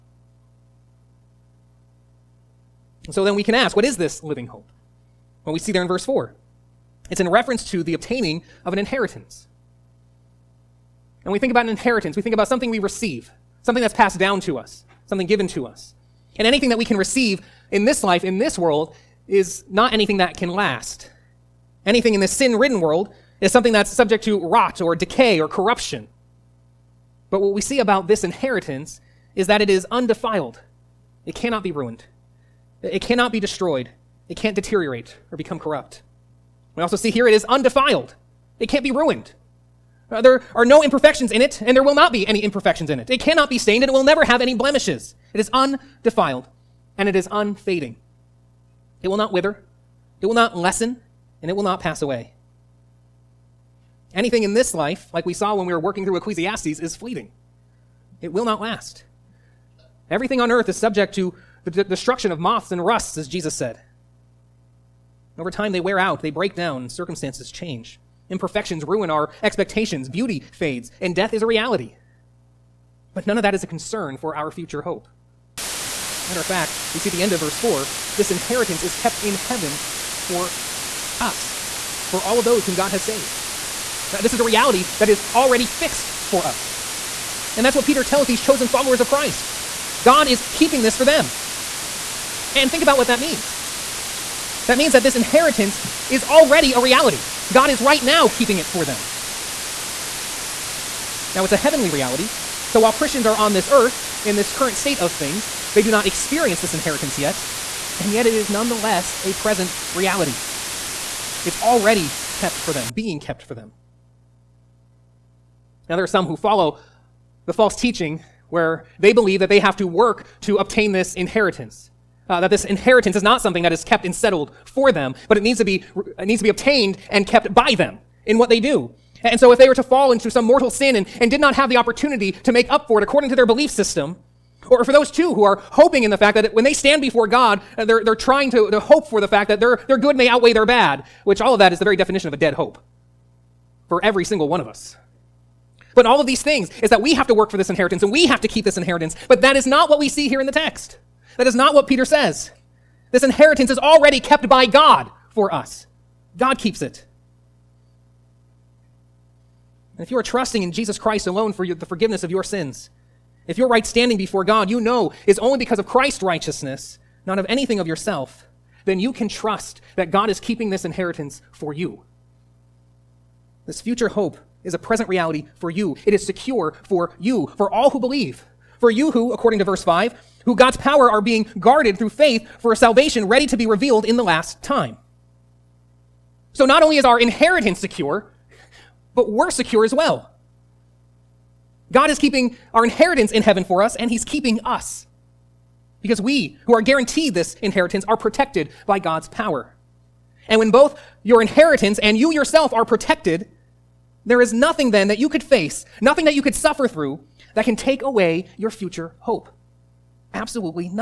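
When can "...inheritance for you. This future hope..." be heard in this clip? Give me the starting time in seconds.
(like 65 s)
170 s.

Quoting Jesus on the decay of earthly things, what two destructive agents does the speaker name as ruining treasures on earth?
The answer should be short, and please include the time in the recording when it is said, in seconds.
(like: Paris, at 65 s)
moths and rusts, at 62 s.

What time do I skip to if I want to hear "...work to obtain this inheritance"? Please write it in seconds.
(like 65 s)
119 s.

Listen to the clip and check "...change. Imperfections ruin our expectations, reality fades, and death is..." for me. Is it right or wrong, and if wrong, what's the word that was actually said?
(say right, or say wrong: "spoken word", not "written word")
wrong: "beauty", not "reality".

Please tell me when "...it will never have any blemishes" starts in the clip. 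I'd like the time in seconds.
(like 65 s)
43 s.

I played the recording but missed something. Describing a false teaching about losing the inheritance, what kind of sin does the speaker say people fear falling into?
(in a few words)
mortal sin.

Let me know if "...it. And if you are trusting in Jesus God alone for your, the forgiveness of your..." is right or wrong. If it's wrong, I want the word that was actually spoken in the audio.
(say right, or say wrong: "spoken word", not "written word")
wrong: "Christ", not "God".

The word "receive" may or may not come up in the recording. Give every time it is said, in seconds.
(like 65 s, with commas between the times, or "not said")
12 s, 16 s.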